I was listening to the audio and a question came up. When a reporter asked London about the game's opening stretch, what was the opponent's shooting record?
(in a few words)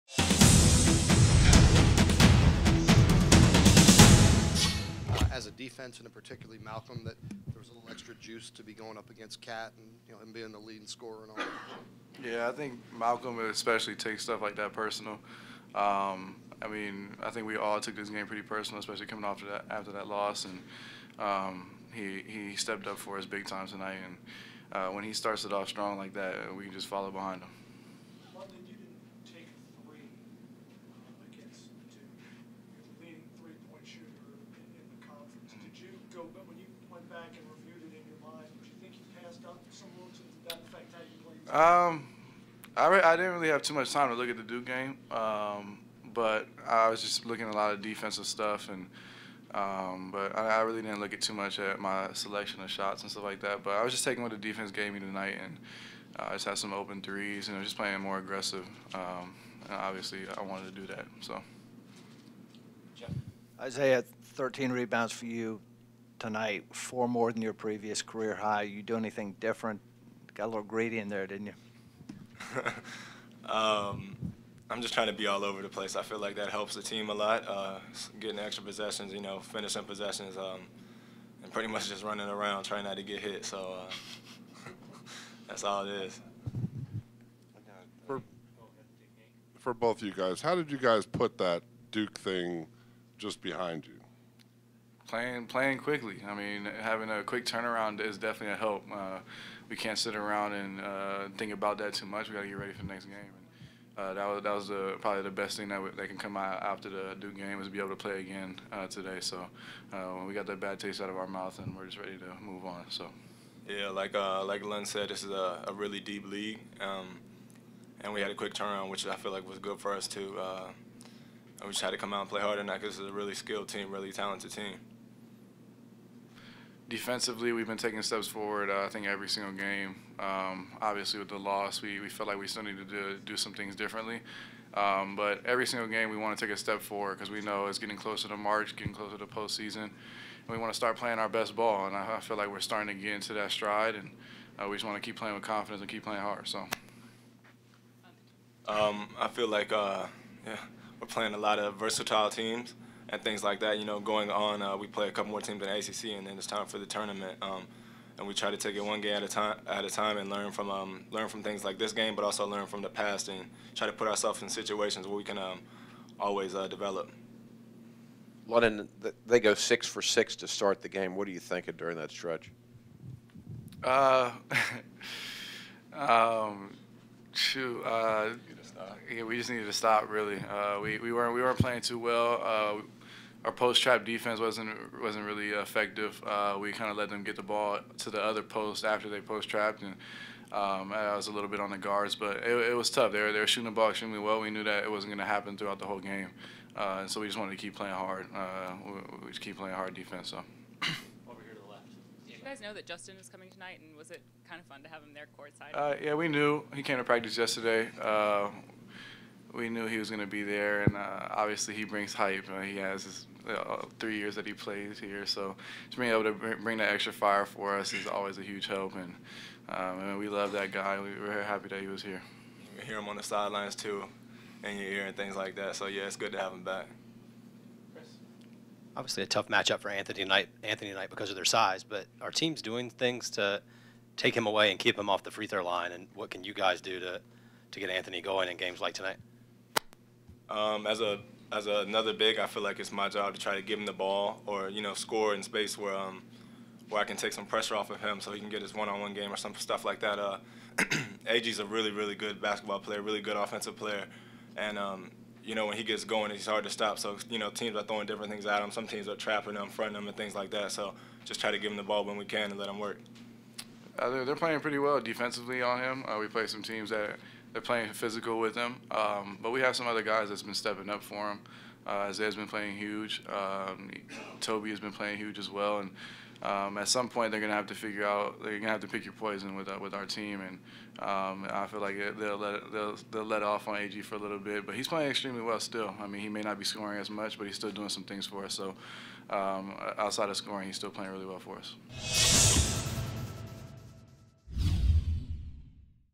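6 for 6.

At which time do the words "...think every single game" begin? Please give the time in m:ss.
2:08.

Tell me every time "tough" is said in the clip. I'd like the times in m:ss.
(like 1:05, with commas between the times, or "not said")
3:12, 3:49.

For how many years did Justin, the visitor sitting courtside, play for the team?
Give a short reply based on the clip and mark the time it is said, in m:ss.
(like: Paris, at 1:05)
3, at 3:33.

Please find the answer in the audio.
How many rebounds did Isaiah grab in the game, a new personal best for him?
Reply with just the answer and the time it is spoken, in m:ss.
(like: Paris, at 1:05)
13, at 1:04.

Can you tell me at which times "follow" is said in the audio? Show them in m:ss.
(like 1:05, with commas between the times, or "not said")
0:26.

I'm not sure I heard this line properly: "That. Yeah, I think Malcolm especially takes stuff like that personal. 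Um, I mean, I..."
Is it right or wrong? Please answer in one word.
right.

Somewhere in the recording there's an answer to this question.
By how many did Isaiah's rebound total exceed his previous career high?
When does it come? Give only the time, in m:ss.
1:06.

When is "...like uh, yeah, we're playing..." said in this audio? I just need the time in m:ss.
2:29.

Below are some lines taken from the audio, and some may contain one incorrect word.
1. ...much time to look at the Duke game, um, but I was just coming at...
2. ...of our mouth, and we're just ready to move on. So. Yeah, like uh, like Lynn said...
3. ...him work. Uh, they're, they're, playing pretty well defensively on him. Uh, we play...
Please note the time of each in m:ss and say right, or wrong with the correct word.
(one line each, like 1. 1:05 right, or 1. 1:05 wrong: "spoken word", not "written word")
1. 0:43 wrong: "looking", not "coming"
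2. 1:51 right
3. 4:22 right.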